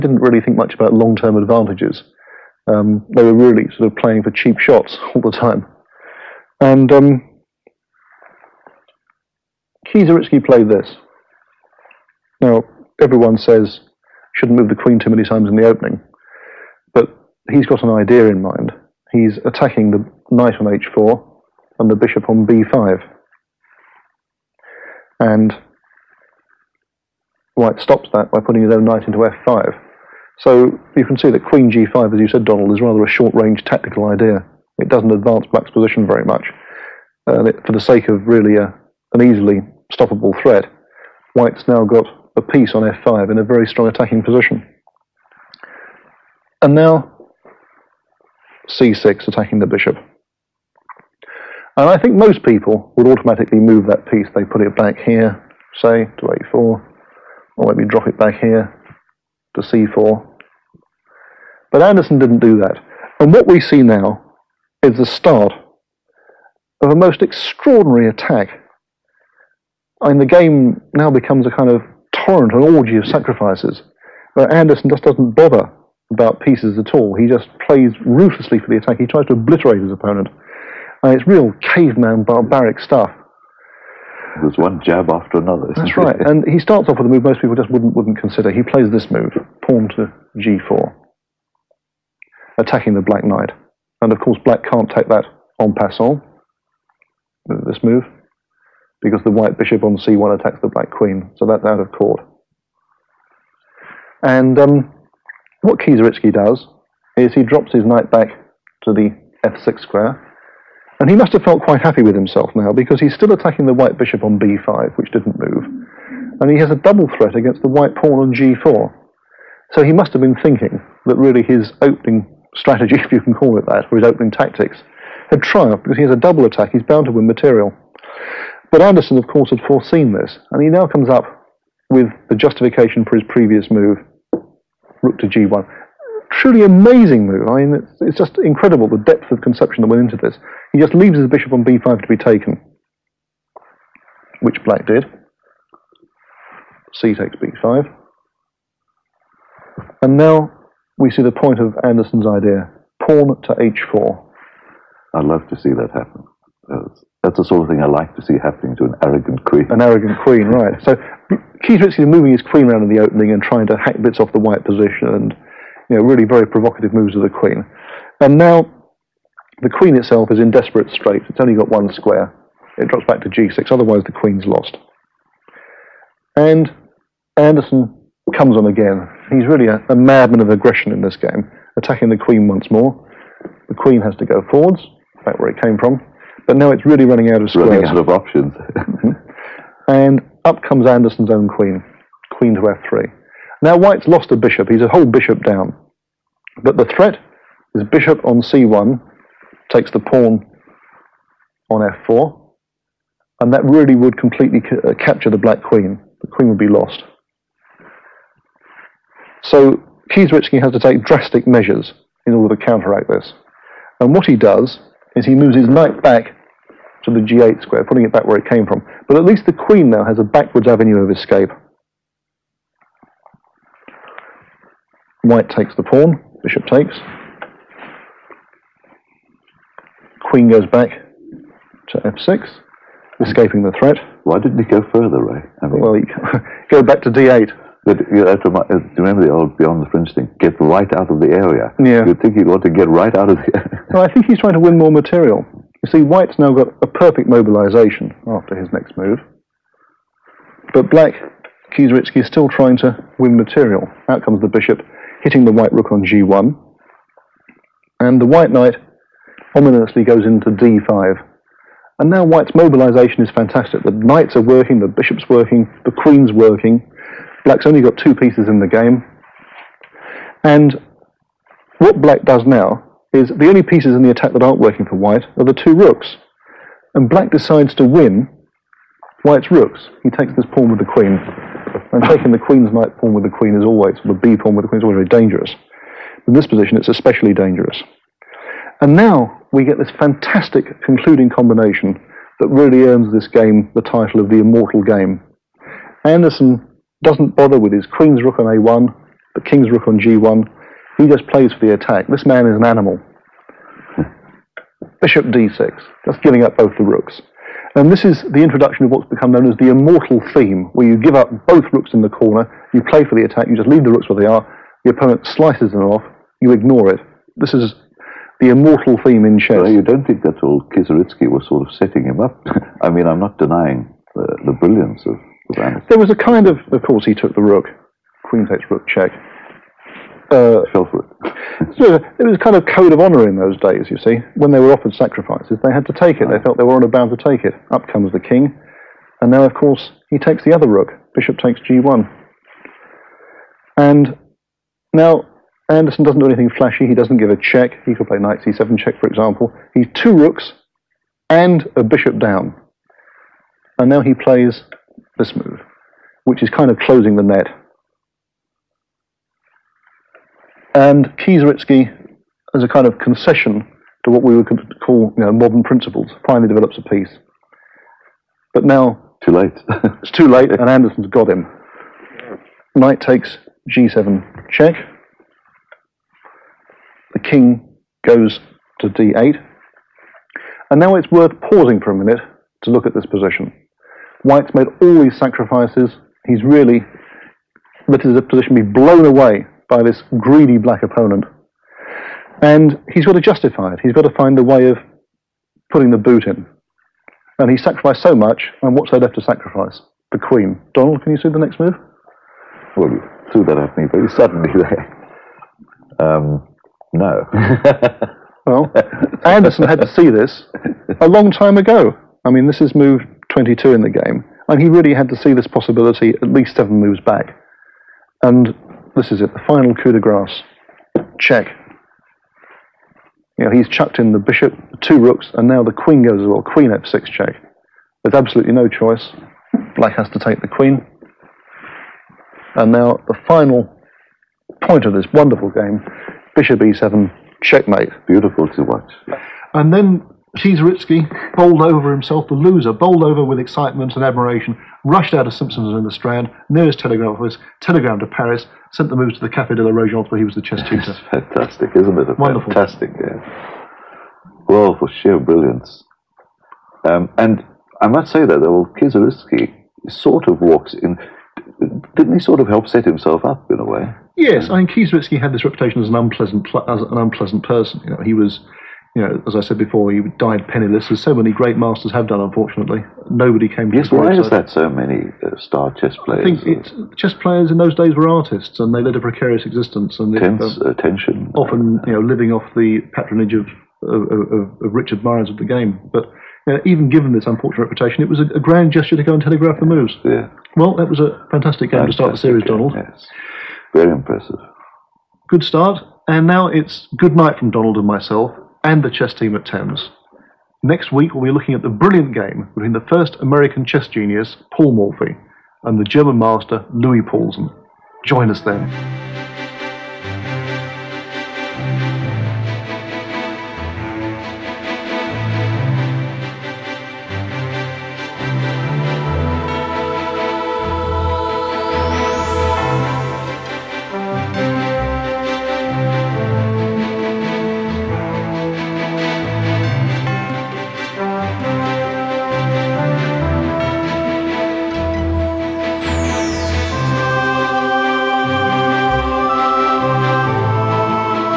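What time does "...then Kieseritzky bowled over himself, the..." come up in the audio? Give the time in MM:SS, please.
07:19.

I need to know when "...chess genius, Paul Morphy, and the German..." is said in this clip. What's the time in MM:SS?
08:23.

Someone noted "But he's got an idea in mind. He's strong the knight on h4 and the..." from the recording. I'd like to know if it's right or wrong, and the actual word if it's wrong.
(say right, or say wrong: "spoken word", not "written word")
wrong: "attacking", not "strong".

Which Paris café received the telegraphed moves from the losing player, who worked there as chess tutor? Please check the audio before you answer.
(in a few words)
Cafe de la Régence.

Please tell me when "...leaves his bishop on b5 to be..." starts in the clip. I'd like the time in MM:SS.
02:20.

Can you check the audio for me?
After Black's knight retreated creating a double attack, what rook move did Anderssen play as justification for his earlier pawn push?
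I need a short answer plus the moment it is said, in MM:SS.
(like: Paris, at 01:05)
Rook to g1, at 02:15.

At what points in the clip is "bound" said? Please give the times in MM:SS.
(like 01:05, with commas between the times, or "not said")
02:06, 05:36.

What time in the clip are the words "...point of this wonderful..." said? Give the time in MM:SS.
07:14.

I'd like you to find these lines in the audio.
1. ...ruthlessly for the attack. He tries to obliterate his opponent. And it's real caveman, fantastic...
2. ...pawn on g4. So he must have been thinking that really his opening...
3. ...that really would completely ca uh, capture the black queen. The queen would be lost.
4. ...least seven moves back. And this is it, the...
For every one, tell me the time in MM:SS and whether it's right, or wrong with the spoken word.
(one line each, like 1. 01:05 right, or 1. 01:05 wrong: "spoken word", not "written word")
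1. 01:18 wrong: "barbaric", not "fantastic"
2. 01:57 right
3. 03:23 right
4. 06:56 right.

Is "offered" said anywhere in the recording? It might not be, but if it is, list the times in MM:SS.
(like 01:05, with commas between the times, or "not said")
05:34.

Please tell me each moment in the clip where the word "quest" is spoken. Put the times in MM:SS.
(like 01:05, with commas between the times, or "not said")
not said.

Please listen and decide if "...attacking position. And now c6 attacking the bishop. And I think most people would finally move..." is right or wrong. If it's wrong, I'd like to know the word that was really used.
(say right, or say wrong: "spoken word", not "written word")
wrong: "automatically", not "finally".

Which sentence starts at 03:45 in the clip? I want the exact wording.
White takes the pawn, bishop takes.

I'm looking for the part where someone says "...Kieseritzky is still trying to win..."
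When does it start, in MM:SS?
04:11.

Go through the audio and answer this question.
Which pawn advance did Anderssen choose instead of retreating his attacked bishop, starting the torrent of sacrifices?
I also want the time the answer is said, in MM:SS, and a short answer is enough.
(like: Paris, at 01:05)
Pawn to g4, at 01:29.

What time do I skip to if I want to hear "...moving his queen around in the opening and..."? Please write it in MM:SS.
02:42.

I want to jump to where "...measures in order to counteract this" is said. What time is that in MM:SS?
03:31.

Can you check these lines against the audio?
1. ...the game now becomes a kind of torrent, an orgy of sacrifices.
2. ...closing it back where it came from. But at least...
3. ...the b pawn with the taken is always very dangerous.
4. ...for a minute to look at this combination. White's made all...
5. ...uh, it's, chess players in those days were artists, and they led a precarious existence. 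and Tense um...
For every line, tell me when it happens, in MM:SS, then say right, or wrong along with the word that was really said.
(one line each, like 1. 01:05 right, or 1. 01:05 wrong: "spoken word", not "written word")
1. 01:10 right
2. 03:37 wrong: "putting", not "closing"
3. 04:44 wrong: "queen", not "taken"
4. 06:21 wrong: "position", not "combination"
5. 07:56 right.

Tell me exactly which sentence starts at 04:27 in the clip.
Black's only got two pieces in the game.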